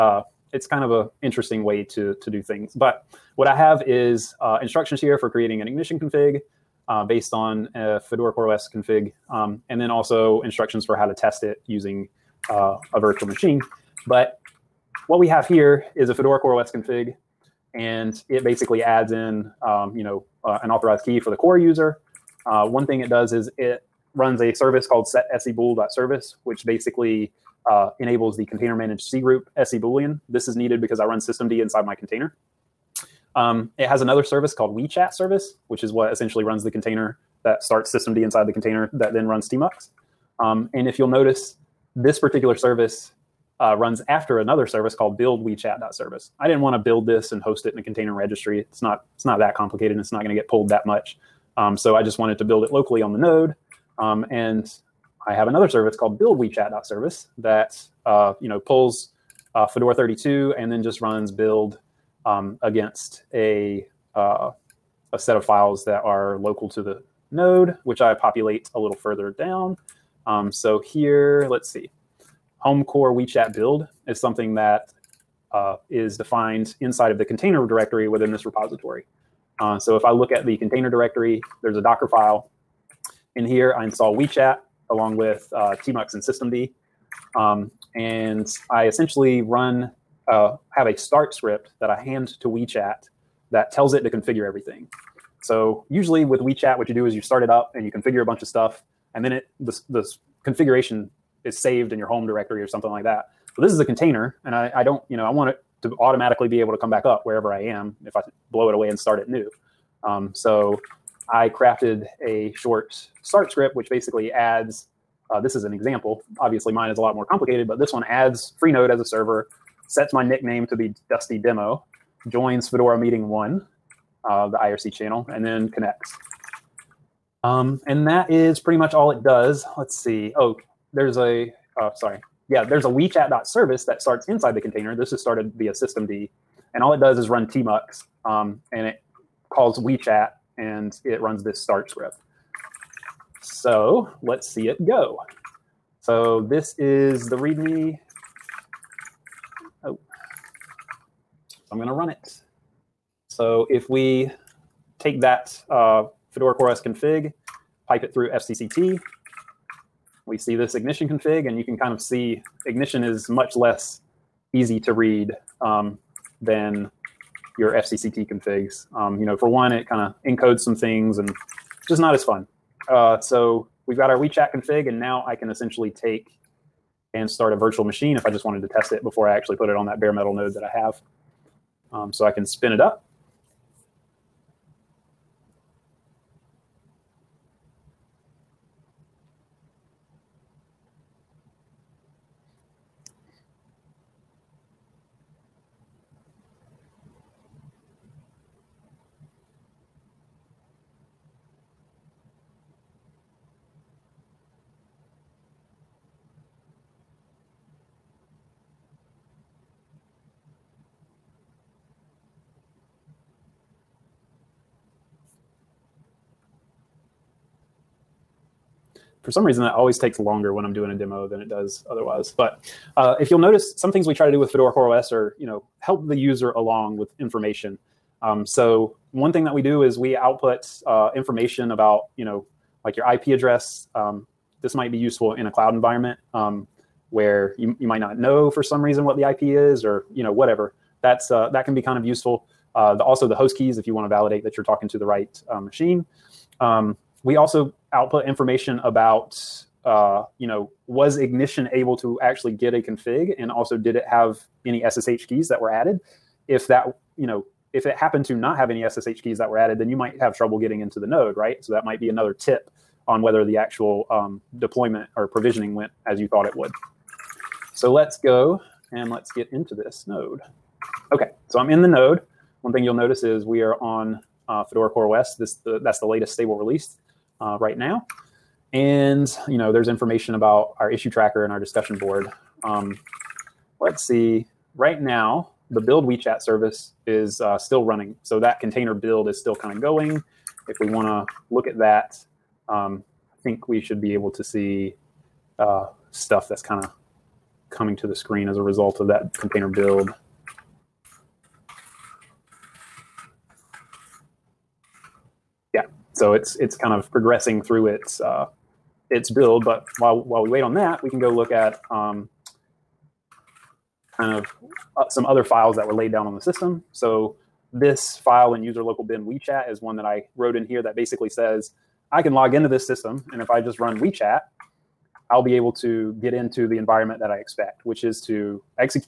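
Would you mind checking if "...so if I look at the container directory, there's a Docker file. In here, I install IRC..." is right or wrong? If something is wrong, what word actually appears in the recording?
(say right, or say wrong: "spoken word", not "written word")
wrong: "WeeChat", not "IRC".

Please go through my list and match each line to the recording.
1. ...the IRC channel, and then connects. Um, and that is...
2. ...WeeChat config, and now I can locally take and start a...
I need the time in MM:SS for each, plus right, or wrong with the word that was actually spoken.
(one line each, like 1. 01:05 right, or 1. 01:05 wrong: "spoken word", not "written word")
1. 02:04 right
2. 02:54 wrong: "essentially", not "locally".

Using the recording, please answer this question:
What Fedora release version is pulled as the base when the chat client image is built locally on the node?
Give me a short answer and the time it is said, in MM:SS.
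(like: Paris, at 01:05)
Fedora 32, at 00:59.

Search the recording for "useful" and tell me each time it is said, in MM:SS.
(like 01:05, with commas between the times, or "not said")
03:54, 04:02.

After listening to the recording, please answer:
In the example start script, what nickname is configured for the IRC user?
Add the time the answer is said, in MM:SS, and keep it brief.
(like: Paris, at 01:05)
Dusty Demo, at 02:01.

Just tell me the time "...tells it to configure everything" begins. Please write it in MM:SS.
01:33.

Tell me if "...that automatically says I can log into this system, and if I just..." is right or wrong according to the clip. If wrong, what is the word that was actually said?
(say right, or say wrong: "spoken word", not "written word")
wrong: "basically", not "automatically".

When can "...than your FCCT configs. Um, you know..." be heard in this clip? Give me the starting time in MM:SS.
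02:46.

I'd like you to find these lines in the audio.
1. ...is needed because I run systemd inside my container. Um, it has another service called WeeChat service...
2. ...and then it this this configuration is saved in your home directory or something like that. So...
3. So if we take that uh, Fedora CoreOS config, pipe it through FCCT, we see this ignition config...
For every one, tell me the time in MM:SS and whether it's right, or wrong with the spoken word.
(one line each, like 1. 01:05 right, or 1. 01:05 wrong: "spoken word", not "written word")
1. 00:30 right
2. 01:39 right
3. 02:33 right.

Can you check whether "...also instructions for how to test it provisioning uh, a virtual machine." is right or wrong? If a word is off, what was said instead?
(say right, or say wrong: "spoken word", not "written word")
wrong: "using", not "provisioning".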